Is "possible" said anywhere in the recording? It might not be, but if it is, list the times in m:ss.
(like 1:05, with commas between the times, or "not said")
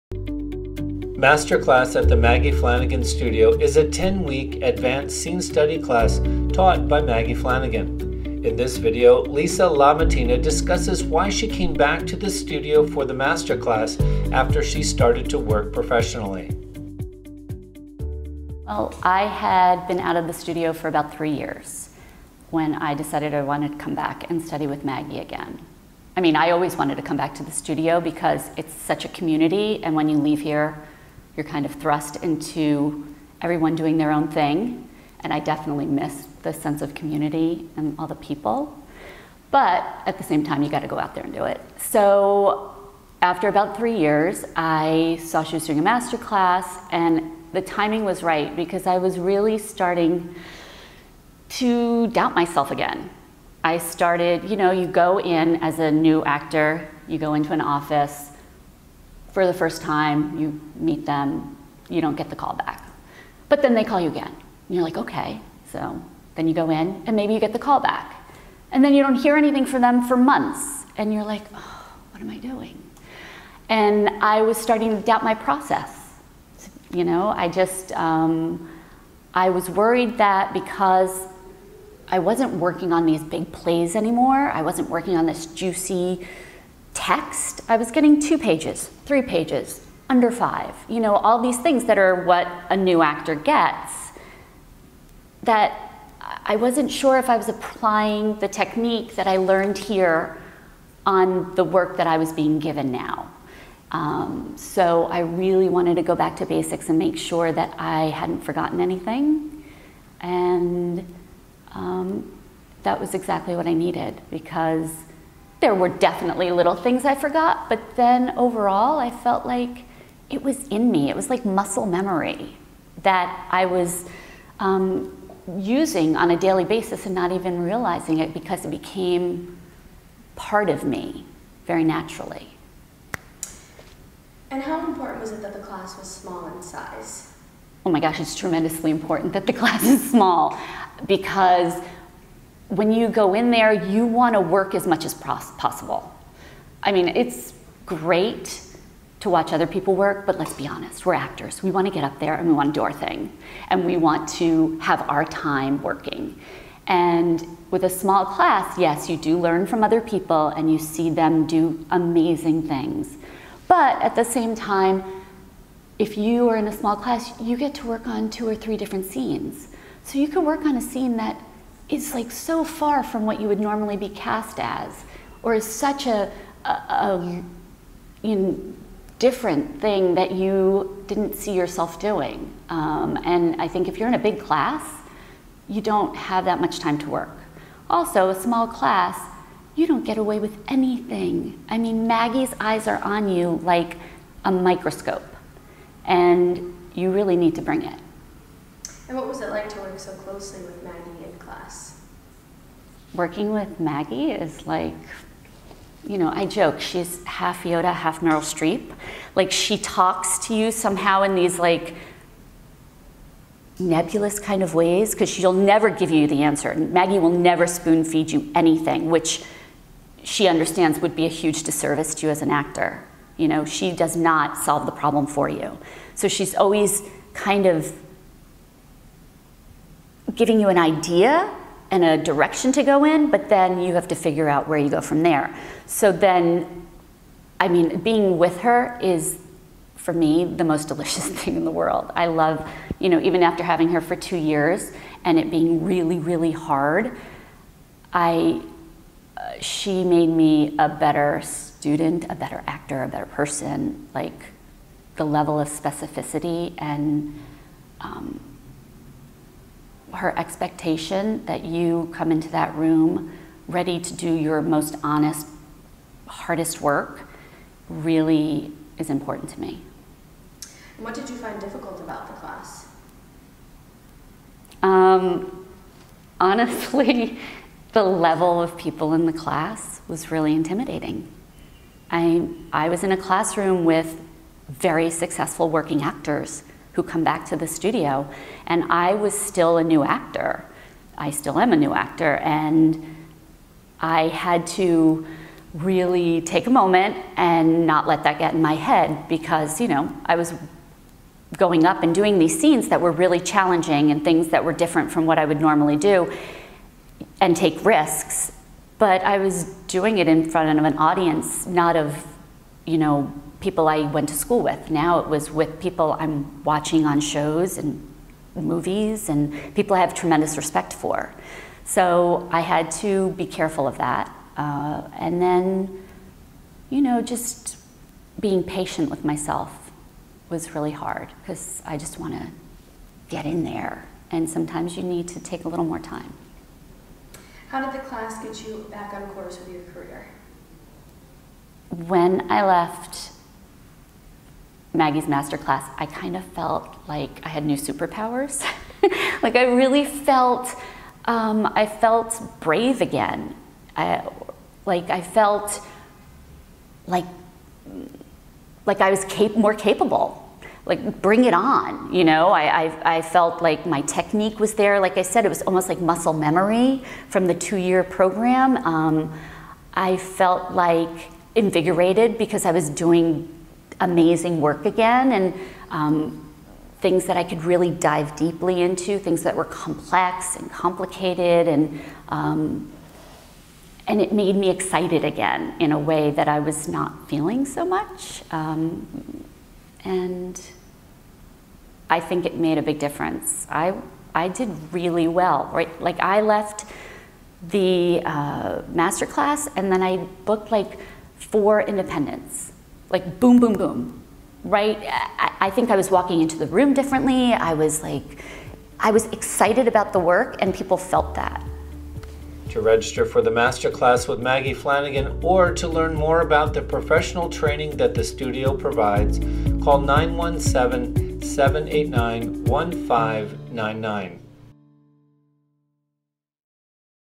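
2:25.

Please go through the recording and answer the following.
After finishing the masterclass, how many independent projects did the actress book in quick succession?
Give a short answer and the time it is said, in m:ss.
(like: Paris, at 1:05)
4, at 6:41.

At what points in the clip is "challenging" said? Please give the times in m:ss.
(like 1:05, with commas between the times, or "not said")
5:03.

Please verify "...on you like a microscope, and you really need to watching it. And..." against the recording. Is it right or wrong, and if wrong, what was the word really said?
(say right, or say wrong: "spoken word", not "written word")
wrong: "bring", not "watching".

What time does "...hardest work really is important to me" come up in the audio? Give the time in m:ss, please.
4:26.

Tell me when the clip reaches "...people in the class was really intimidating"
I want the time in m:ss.
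4:38.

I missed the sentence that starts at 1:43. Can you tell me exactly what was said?
Um, so I really wanted to go back to basics and make sure that I hadn't forgotten anything.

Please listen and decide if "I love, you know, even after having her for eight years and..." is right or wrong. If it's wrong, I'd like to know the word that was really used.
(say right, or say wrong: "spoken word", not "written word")
wrong: "two", not "eight".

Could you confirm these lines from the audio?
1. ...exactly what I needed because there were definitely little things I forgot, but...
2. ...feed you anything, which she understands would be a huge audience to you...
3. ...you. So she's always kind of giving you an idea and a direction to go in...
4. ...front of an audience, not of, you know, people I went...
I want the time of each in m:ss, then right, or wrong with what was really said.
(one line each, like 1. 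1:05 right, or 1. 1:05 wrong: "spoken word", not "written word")
1. 1:53 right
2. 3:38 wrong: "disservice", not "audience"
3. 3:45 right
4. 5:10 right.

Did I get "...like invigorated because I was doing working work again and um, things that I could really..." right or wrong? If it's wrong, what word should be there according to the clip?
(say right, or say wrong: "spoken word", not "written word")
wrong: "amazing", not "working".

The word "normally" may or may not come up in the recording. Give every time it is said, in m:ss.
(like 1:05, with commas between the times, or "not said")
2:53, 5:05.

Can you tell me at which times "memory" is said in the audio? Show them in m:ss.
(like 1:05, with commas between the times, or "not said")
2:01, 6:06.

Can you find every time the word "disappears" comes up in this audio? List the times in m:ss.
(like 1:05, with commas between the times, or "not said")
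not said.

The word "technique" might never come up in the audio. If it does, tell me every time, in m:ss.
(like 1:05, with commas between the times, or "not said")
1:38, 6:04.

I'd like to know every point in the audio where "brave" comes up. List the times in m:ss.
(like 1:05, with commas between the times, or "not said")
5:52.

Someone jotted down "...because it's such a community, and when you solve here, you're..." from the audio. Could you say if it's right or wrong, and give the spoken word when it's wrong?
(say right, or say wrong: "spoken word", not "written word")
wrong: "leave", not "solve".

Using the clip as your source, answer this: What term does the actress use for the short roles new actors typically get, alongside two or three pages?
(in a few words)
under five.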